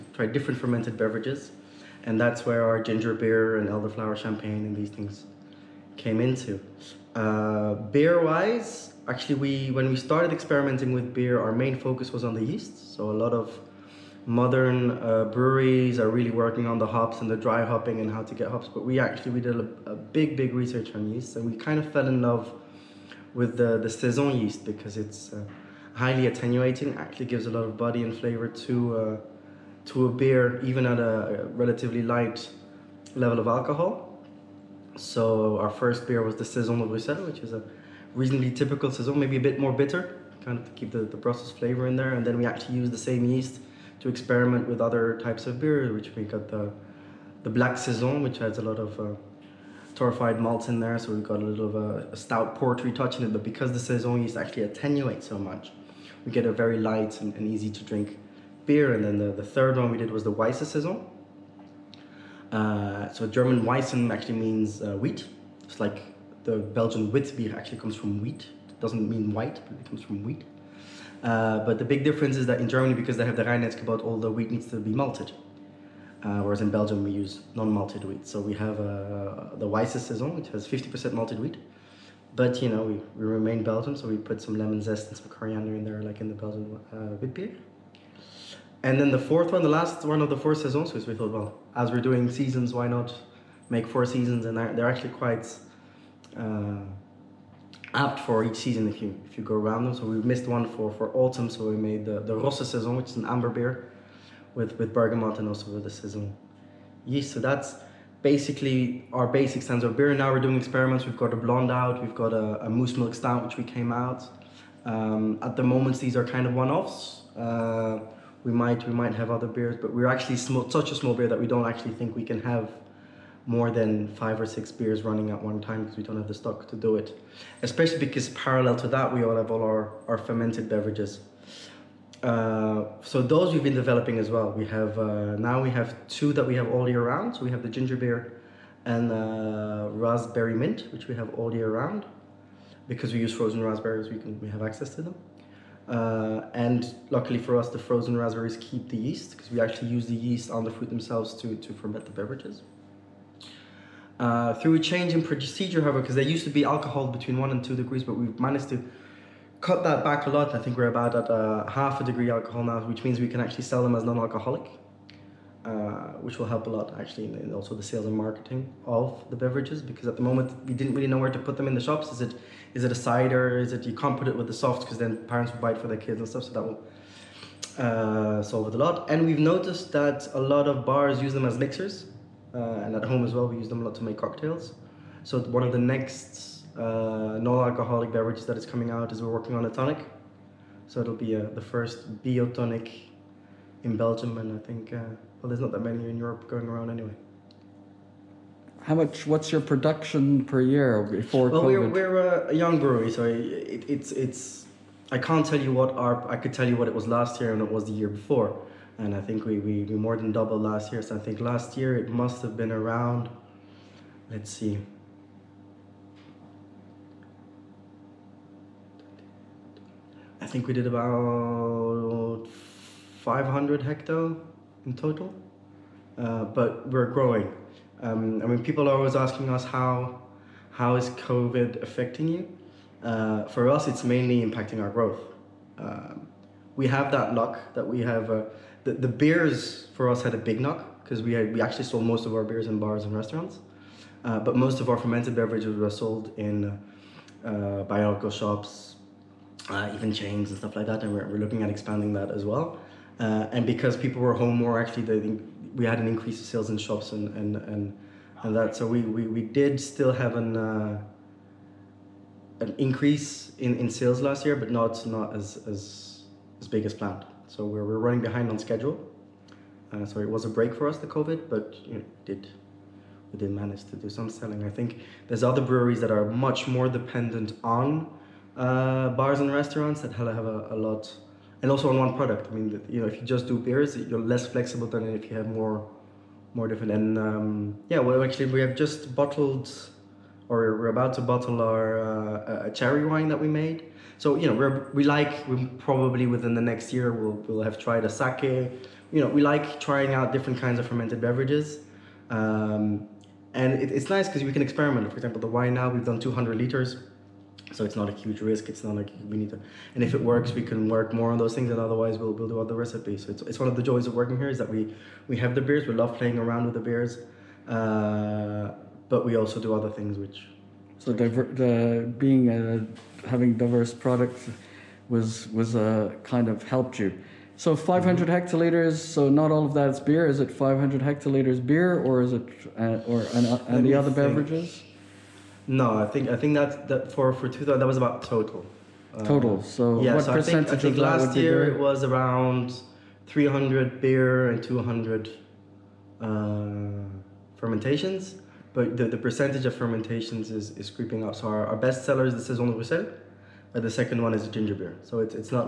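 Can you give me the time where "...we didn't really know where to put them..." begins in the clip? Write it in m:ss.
2:50.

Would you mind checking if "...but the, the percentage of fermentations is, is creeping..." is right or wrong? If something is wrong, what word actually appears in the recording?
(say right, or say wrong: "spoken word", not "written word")
right.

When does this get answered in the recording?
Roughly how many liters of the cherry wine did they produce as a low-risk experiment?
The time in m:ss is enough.
5:06.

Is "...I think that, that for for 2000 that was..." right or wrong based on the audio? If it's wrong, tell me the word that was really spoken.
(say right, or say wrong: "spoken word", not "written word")
right.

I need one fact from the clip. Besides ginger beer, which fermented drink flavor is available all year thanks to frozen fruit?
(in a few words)
raspberry mint.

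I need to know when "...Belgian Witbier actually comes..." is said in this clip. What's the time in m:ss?
1:06.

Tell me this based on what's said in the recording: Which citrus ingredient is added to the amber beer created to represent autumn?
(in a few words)
bergamot.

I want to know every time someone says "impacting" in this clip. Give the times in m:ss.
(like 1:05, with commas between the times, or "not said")
3:54.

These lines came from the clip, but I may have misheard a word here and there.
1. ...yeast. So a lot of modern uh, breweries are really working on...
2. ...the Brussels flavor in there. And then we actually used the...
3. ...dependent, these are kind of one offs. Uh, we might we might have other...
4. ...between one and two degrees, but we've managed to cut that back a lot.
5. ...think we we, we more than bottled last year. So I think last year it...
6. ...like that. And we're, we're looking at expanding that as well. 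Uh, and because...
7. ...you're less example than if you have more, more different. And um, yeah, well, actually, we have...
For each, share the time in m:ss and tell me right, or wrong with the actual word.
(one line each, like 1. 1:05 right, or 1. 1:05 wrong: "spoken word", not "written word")
1. 0:12 right
2. 0:41 right
3. 1:55 wrong: "moment", not "dependent"
4. 2:37 right
5. 3:29 wrong: "doubled", not "bottled"
6. 4:10 right
7. 4:43 wrong: "flexible", not "example".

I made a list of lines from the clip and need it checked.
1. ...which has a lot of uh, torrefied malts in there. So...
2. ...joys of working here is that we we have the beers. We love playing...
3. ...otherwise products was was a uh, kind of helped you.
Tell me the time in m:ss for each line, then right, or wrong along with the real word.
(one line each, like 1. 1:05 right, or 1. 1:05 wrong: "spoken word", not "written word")
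1. 0:48 right
2. 5:13 right
3. 5:23 wrong: "diverse", not "otherwise".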